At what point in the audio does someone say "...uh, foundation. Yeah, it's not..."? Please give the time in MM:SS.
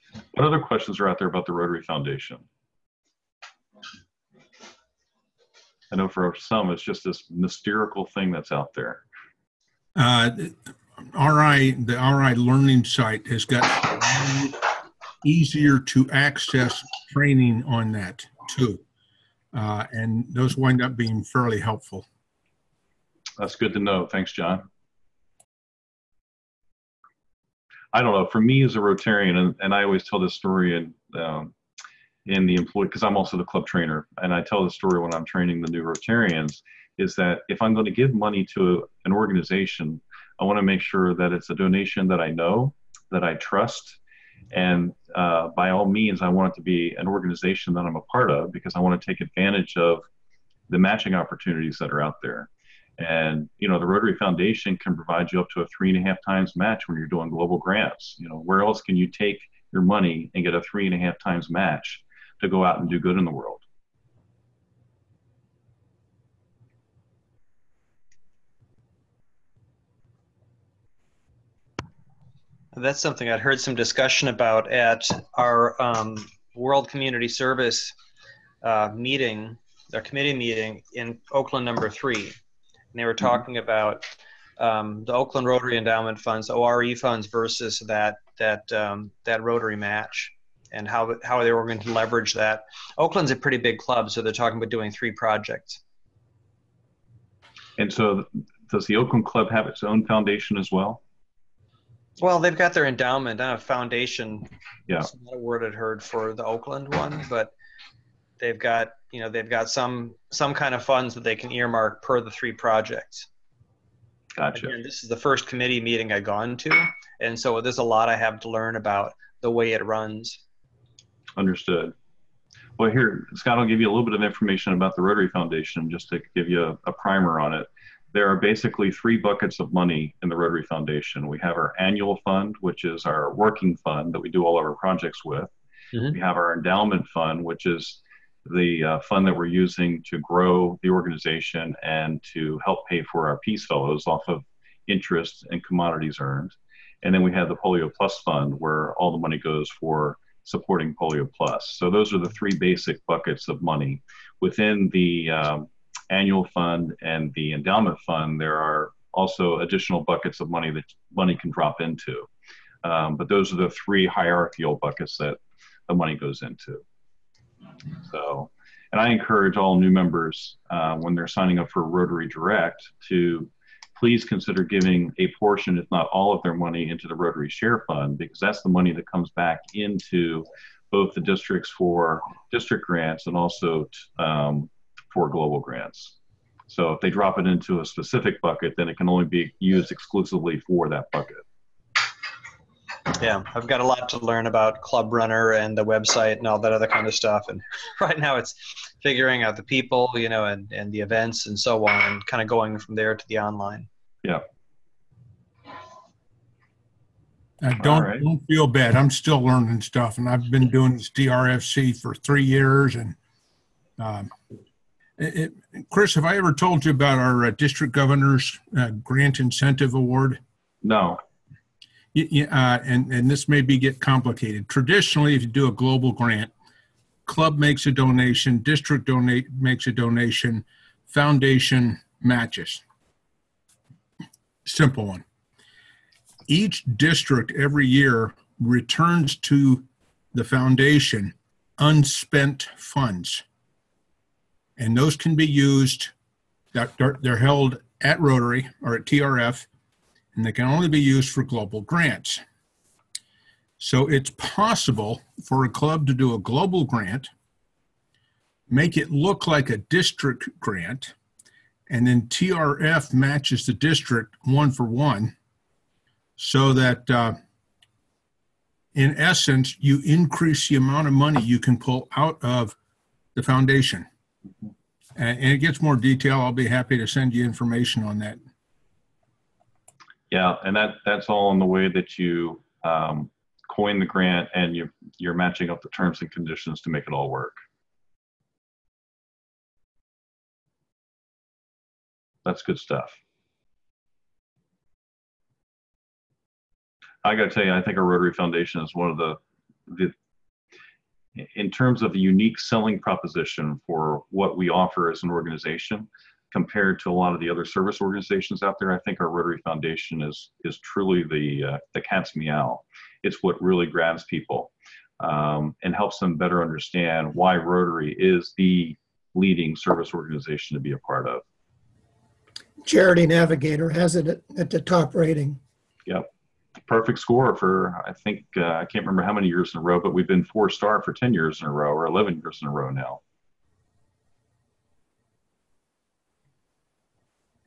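01:43.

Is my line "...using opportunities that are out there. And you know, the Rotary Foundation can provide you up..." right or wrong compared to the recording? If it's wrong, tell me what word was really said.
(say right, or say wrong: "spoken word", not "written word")
wrong: "matching", not "using".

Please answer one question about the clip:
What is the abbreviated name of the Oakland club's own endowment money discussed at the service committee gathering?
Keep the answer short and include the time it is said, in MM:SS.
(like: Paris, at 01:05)
ORE funds, at 01:26.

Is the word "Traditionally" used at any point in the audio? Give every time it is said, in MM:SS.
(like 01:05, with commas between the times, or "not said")
03:44.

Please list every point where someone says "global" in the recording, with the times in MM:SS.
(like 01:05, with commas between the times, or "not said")
00:57, 03:05, 03:45, 04:11, 04:16.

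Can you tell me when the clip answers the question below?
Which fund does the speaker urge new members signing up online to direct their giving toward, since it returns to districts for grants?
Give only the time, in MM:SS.
02:57.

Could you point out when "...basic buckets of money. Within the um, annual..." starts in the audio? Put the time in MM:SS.
02:32.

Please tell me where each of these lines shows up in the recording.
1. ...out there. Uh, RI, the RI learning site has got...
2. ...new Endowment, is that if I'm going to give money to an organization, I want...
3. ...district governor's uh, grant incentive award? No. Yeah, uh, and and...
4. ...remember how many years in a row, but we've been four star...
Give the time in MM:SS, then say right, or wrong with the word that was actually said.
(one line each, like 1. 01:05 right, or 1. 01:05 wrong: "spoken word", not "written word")
1. 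00:08 right
2. 00:35 wrong: "Rotarians", not "Endowment"
3. 03:37 right
4. 05:29 right.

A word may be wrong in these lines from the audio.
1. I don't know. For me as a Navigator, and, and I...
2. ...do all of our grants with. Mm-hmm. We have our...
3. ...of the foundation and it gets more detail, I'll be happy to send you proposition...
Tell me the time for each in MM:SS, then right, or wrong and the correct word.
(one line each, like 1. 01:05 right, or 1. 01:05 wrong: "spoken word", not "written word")
1. 00:27 wrong: "Rotarian", not "Navigator"
2. 02:14 wrong: "projects", not "grants"
3. 04:32 wrong: "information", not "proposition".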